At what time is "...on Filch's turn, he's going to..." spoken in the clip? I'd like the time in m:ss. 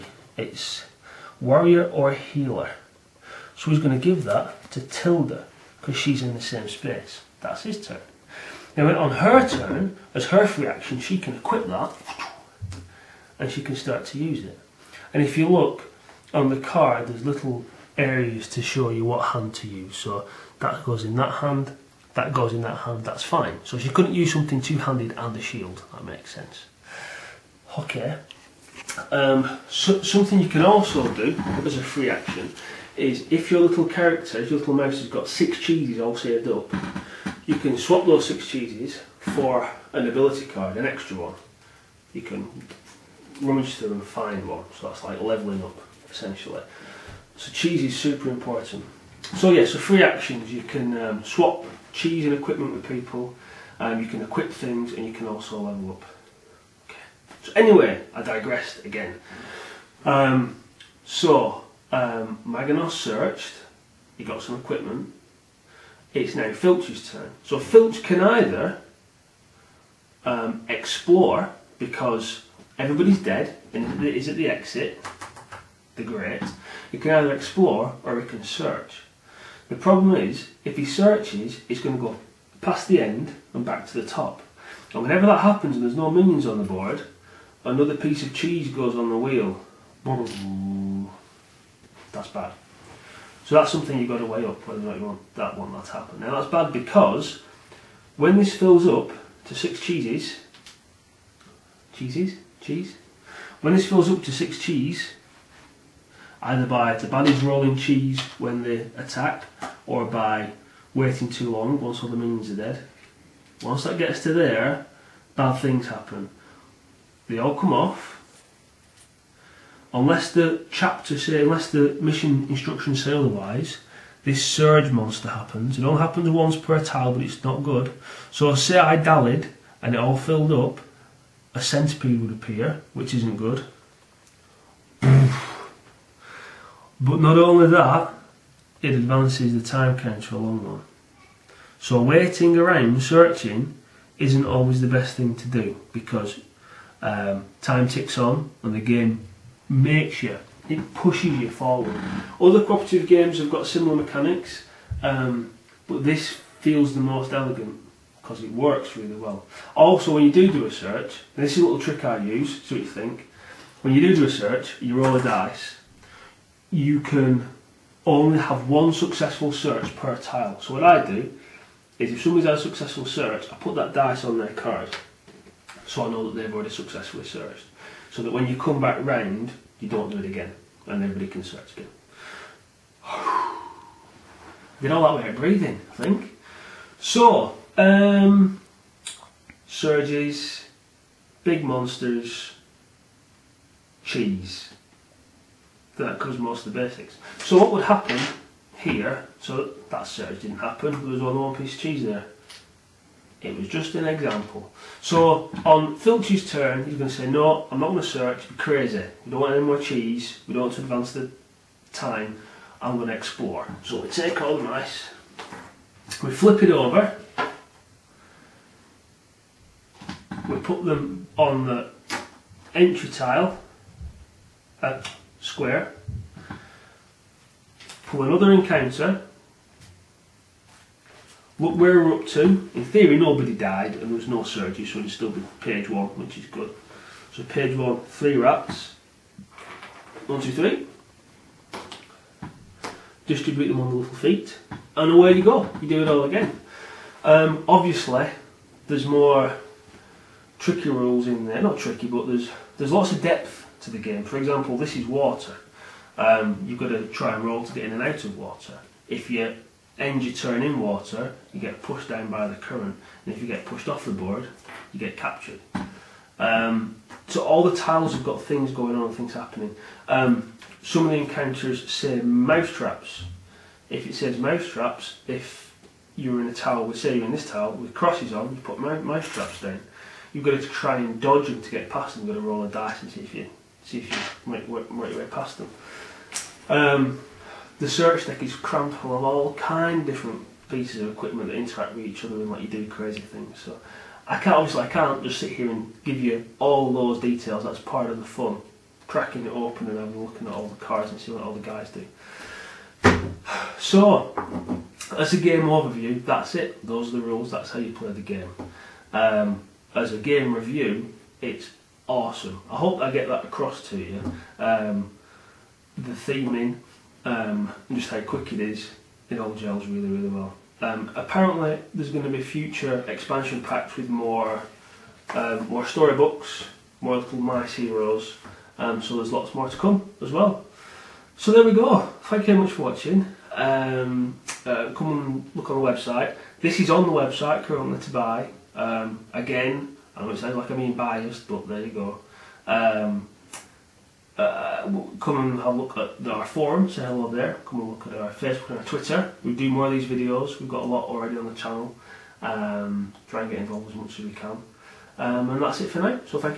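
3:25.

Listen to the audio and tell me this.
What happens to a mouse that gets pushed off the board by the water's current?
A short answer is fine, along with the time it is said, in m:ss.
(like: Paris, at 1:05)
Captured, at 4:24.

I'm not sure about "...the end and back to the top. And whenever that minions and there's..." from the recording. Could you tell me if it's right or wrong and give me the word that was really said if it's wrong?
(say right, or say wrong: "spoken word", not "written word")
wrong: "happens", not "minions".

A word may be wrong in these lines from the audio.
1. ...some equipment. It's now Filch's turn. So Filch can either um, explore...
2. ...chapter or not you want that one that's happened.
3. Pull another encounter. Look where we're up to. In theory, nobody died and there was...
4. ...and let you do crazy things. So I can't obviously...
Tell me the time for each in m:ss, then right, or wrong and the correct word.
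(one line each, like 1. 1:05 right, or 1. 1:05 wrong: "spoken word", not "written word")
1. 1:04 right
2. 1:34 wrong: "whether", not "chapter"
3. 3:48 right
4. 4:52 right.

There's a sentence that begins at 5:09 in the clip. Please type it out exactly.
Um, as a game review, it's awesome.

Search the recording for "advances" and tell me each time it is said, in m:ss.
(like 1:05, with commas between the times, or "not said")
2:18, 3:30.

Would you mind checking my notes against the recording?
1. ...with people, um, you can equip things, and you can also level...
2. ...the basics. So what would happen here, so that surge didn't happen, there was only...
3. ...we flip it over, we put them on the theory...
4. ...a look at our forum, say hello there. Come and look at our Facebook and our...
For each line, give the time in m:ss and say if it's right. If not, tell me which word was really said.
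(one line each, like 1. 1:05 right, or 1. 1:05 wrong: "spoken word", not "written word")
1. 0:52 right
2. 3:16 right
3. 3:36 wrong: "entry", not "theory"
4. 5:45 right.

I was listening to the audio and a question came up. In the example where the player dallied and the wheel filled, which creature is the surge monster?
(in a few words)
Centipede.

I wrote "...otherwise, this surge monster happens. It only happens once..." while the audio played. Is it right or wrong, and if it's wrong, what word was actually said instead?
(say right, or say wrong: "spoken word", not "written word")
right.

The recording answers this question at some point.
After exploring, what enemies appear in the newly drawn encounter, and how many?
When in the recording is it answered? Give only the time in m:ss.
3:58.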